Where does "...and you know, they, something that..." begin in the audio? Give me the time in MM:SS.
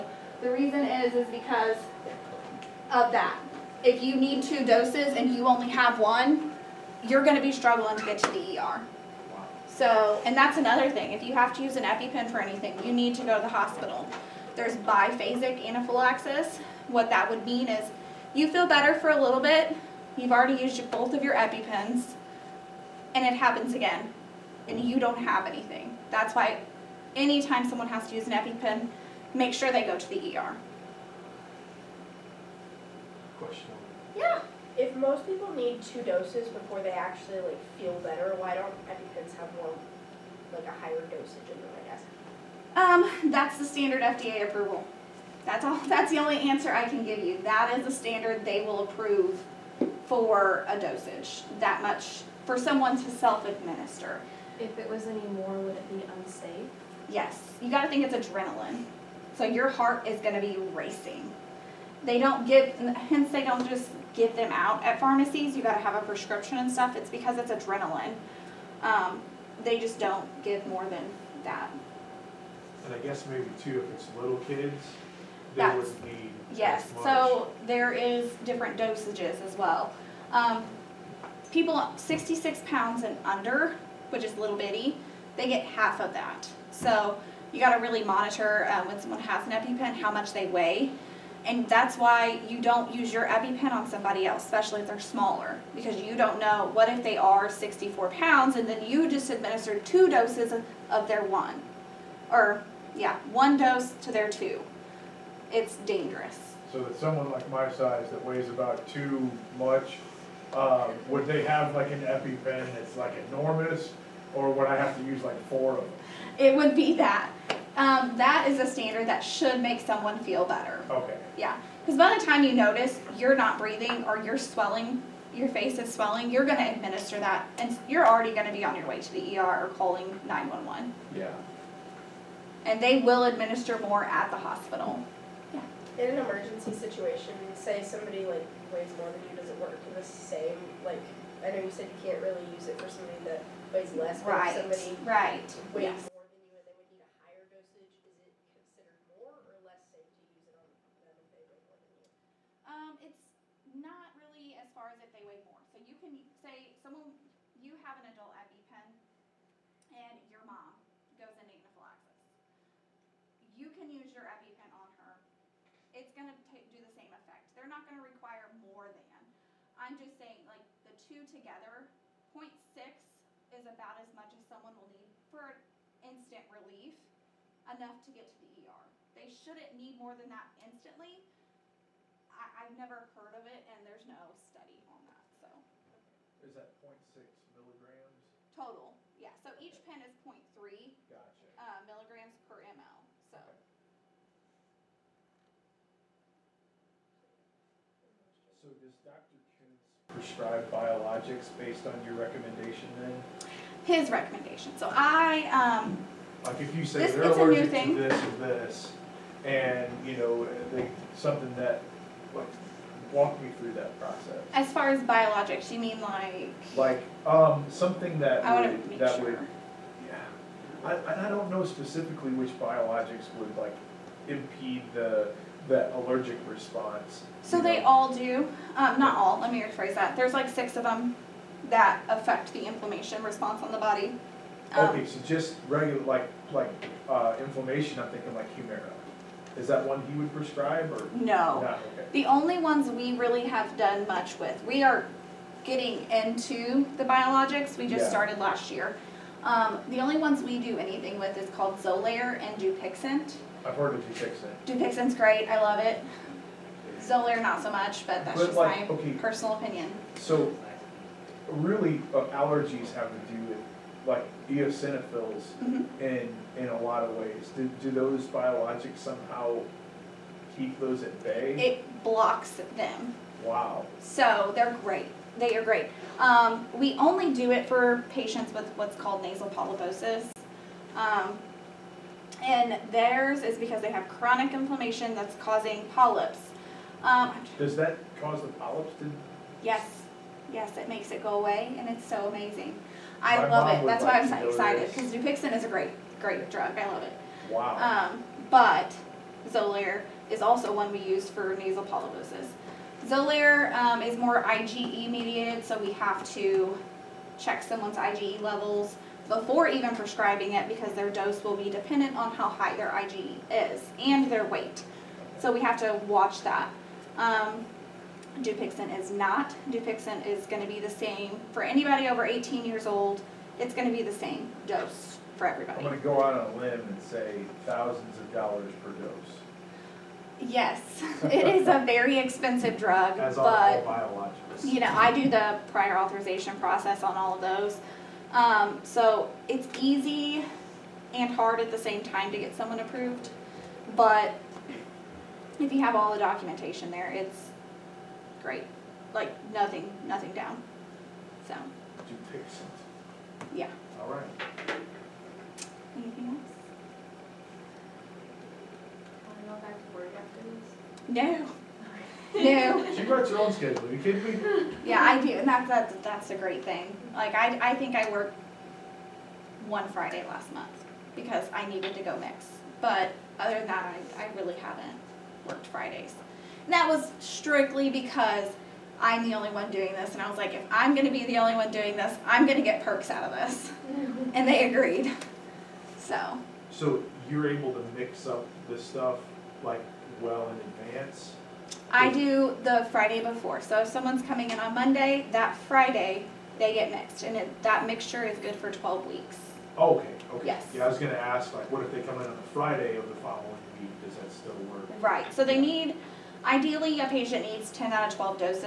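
03:29.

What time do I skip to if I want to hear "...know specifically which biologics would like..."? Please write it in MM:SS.
03:41.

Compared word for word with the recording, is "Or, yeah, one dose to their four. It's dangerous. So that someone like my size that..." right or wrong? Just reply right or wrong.
wrong.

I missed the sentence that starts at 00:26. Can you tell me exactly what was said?
That's why anytime someone has to use an EpiPen, make sure they go to the ER.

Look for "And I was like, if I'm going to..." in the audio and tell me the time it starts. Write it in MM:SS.
06:20.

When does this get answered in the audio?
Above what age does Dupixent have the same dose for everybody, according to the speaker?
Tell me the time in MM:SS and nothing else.
05:22.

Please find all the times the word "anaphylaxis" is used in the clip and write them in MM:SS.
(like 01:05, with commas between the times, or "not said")
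00:15, 02:41.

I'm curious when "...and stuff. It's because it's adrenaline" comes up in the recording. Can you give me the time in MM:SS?
01:06.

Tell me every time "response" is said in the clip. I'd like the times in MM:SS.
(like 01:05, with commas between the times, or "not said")
03:46, 03:53.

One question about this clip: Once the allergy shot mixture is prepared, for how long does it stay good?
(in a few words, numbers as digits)
12 weeks.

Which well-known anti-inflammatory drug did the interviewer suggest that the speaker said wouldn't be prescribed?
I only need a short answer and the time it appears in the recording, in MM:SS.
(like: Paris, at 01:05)
Humira, at 03:58.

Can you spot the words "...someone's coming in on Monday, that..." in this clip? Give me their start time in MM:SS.
06:33.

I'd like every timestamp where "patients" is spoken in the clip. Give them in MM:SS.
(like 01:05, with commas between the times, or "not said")
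04:38, 06:47.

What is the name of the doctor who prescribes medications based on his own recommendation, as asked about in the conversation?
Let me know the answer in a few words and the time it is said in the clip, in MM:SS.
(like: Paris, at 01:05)
Dr. Kunz, at 03:18.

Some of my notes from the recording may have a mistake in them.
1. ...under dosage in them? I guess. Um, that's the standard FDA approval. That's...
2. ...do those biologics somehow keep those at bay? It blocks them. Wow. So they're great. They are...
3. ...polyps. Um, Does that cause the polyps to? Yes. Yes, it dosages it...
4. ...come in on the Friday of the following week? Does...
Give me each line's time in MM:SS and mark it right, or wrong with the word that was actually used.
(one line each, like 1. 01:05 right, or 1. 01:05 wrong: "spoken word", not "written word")
1. 00:40 wrong: "higher", not "under"
2. 04:27 right
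3. 04:45 wrong: "makes", not "dosages"
4. 06:42 right.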